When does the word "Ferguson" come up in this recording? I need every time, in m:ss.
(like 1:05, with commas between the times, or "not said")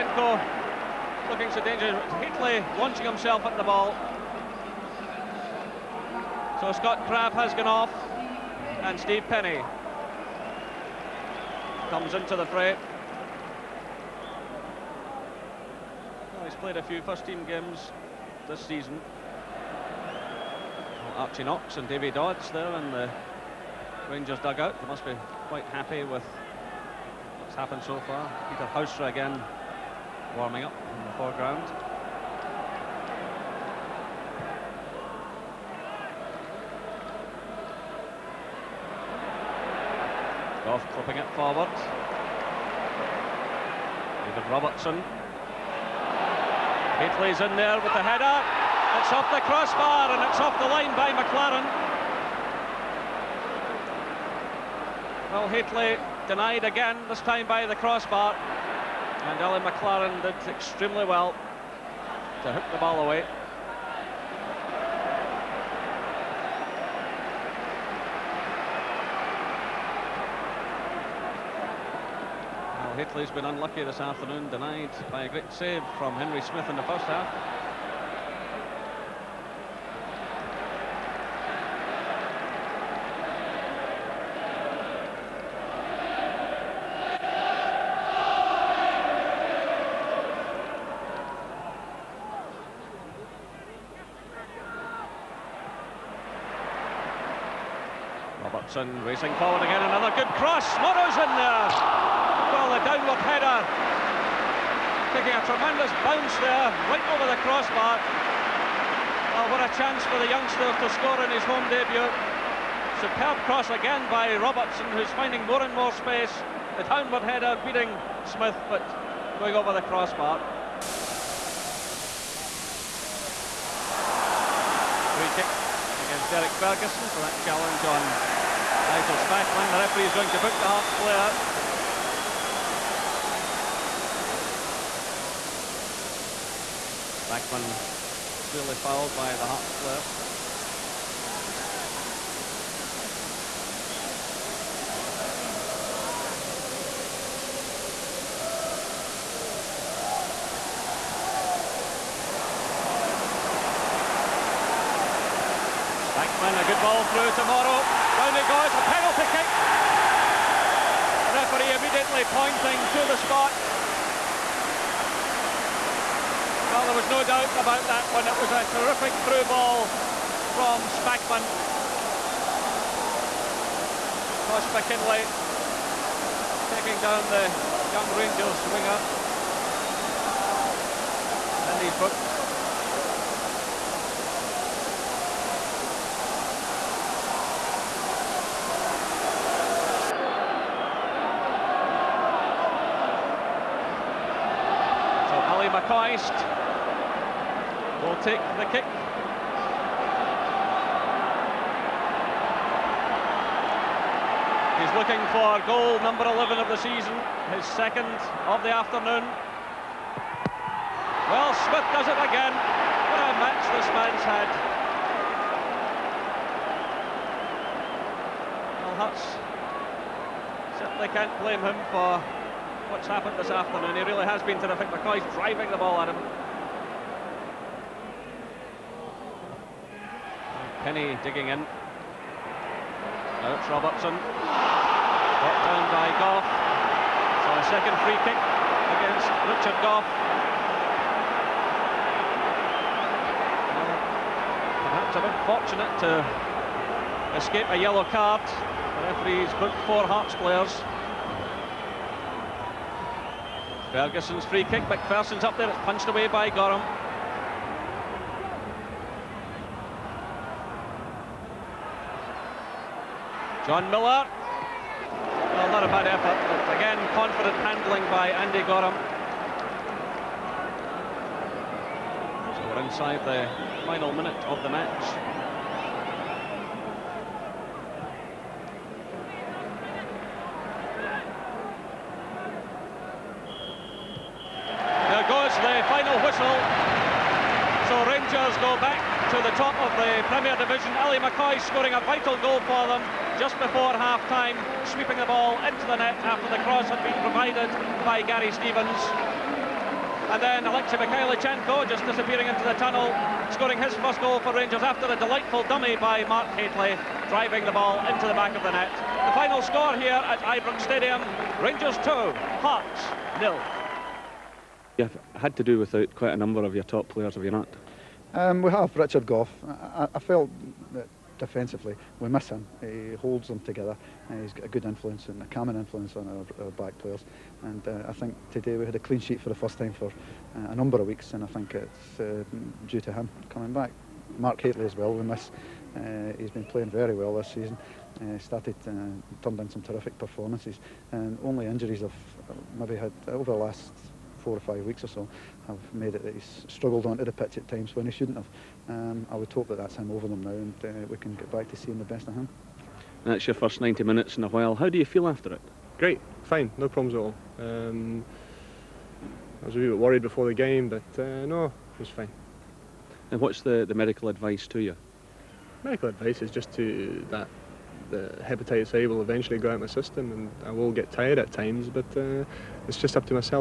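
2:06, 4:13.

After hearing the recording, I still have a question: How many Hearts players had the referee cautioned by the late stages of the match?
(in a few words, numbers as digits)
4.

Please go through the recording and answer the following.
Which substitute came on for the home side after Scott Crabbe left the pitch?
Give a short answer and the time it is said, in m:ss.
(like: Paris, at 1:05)
Steve Penney, at 0:08.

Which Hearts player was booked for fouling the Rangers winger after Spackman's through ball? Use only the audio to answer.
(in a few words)
Tosh McKinlay.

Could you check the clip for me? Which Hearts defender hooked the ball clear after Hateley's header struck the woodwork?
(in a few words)
Alan McLaren.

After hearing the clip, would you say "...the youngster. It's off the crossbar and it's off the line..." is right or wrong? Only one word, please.
wrong.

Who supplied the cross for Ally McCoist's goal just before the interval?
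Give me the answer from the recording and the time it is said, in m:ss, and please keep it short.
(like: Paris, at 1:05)
Gary Stevens, at 4:58.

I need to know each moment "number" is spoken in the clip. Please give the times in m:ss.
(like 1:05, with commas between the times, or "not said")
3:25, 5:16, 5:30.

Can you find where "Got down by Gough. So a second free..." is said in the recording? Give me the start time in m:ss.
3:54.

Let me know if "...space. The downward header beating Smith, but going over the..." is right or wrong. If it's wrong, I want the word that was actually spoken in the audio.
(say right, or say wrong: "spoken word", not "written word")
right.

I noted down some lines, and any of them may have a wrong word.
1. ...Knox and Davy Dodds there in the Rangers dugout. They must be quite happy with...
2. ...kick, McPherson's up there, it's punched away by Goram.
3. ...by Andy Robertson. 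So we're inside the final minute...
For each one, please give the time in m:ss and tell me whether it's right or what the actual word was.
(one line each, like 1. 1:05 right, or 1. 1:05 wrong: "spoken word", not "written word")
1. 0:21 right
2. 4:14 right
3. 4:28 wrong: "Goram", not "Robertson".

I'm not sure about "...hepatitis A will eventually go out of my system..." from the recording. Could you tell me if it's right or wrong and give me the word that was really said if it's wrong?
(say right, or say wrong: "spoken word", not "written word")
right.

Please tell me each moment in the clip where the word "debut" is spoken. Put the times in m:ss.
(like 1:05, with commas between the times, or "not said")
1:51.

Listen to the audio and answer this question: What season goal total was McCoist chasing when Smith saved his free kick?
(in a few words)
11.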